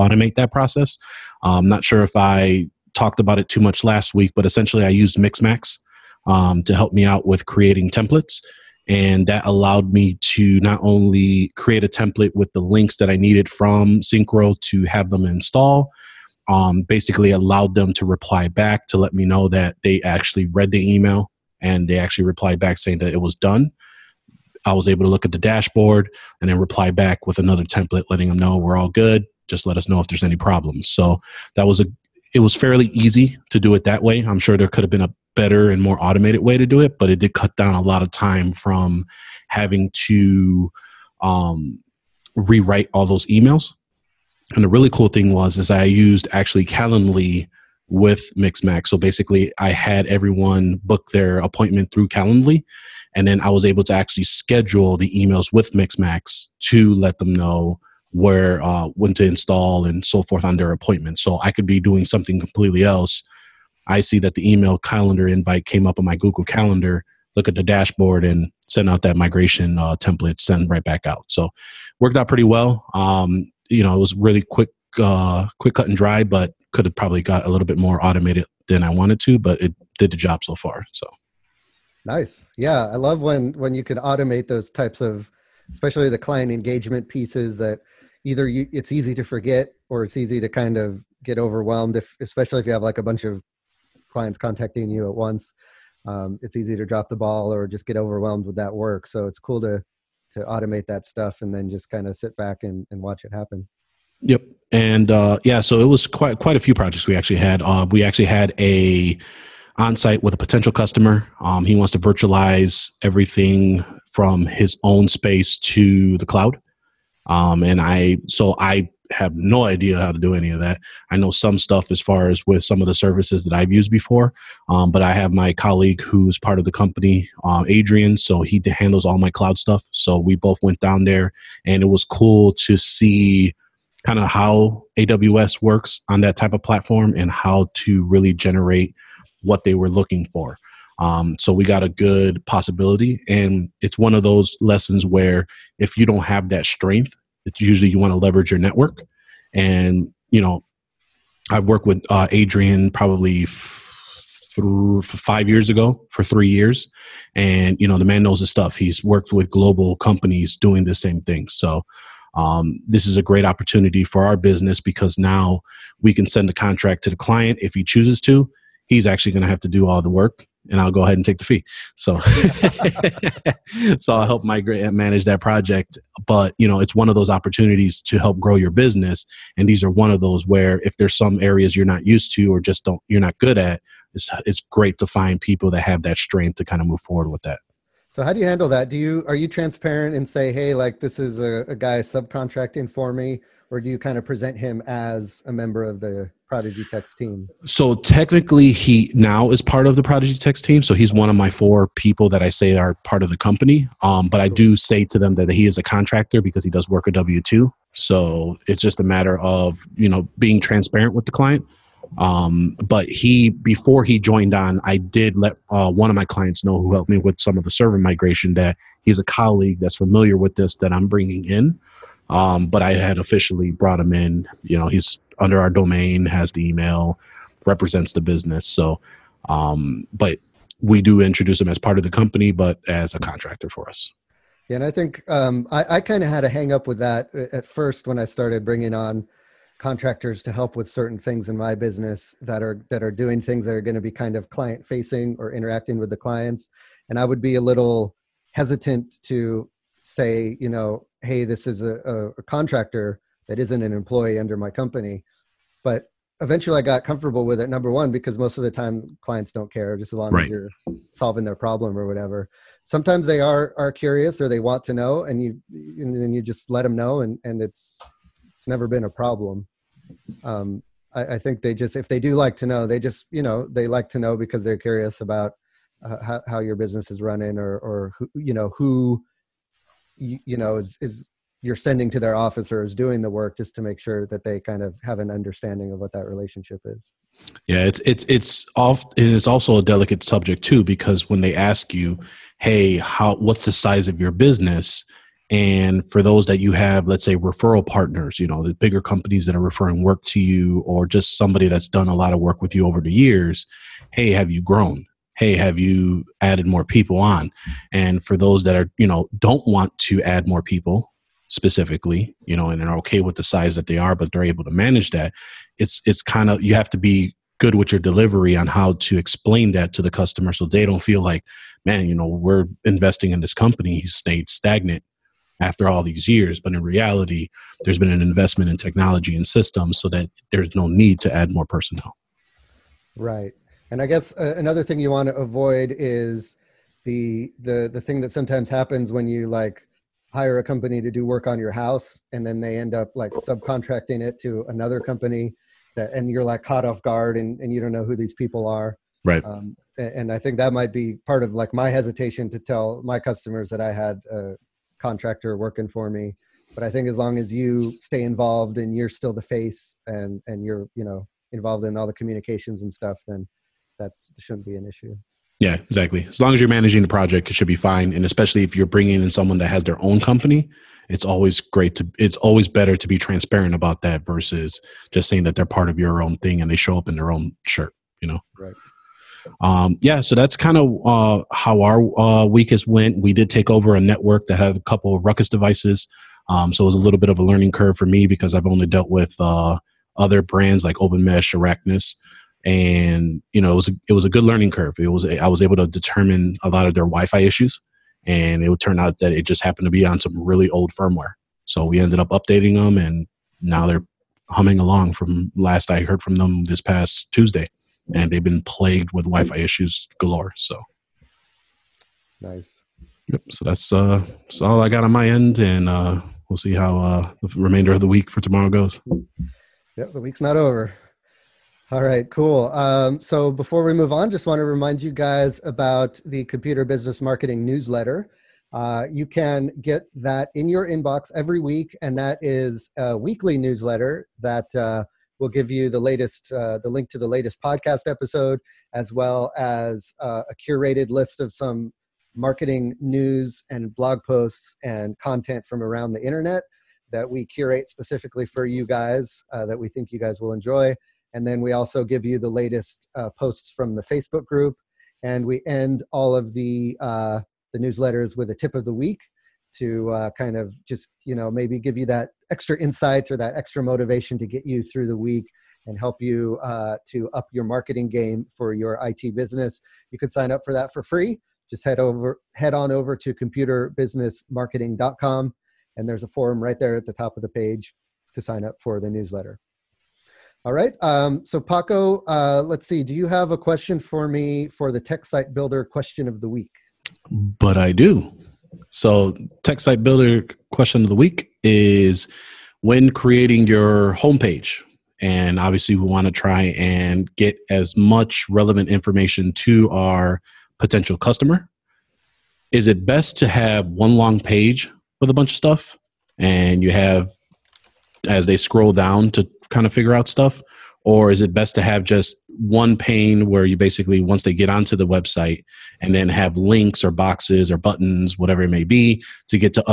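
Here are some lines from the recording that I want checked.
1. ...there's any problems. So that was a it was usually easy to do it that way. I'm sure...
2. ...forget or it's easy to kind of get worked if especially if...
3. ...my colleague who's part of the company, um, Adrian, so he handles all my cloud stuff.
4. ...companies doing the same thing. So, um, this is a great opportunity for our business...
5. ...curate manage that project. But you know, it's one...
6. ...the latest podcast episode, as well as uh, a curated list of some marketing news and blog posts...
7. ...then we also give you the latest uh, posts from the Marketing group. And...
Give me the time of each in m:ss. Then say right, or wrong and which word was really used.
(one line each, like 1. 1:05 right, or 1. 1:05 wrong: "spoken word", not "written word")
1. 0:30 wrong: "fairly", not "usually"
2. 1:29 wrong: "overwhelmed", not "worked"
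3. 2:05 right
4. 2:39 right
5. 2:54 wrong: "migrate", not "curate"
6. 7:17 right
7. 7:31 wrong: "Facebook", not "Marketing".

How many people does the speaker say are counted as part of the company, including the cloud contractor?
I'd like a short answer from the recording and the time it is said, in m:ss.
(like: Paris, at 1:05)
4, at 3:21.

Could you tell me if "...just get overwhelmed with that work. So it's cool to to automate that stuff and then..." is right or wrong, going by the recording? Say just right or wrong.
right.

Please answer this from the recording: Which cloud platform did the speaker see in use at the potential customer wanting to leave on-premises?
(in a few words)
AWS.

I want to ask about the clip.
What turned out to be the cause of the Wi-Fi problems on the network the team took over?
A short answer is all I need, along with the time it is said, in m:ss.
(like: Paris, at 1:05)
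Old firmware, at 6:40.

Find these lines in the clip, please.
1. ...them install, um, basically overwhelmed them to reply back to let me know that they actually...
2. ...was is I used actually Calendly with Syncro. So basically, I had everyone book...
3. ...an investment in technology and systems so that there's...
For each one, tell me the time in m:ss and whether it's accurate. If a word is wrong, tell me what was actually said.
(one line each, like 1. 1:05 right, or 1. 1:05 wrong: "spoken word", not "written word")
1. 0:15 wrong: "allowed", not "overwhelmed"
2. 0:45 wrong: "Mixmax", not "Syncro"
3. 5:28 right.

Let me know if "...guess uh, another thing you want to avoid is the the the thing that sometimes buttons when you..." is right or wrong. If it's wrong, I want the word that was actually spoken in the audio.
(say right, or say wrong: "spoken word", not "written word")
wrong: "happens", not "buttons".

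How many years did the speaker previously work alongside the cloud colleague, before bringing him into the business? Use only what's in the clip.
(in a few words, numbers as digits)
3.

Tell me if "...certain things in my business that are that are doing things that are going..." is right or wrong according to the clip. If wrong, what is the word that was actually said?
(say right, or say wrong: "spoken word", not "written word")
right.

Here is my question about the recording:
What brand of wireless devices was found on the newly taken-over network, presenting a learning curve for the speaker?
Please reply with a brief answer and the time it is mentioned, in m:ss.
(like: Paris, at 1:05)
Ruckus, at 6:25.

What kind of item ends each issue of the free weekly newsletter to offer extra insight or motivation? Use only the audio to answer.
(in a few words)
Tip of the week.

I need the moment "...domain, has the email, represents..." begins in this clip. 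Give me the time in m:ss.
3:45.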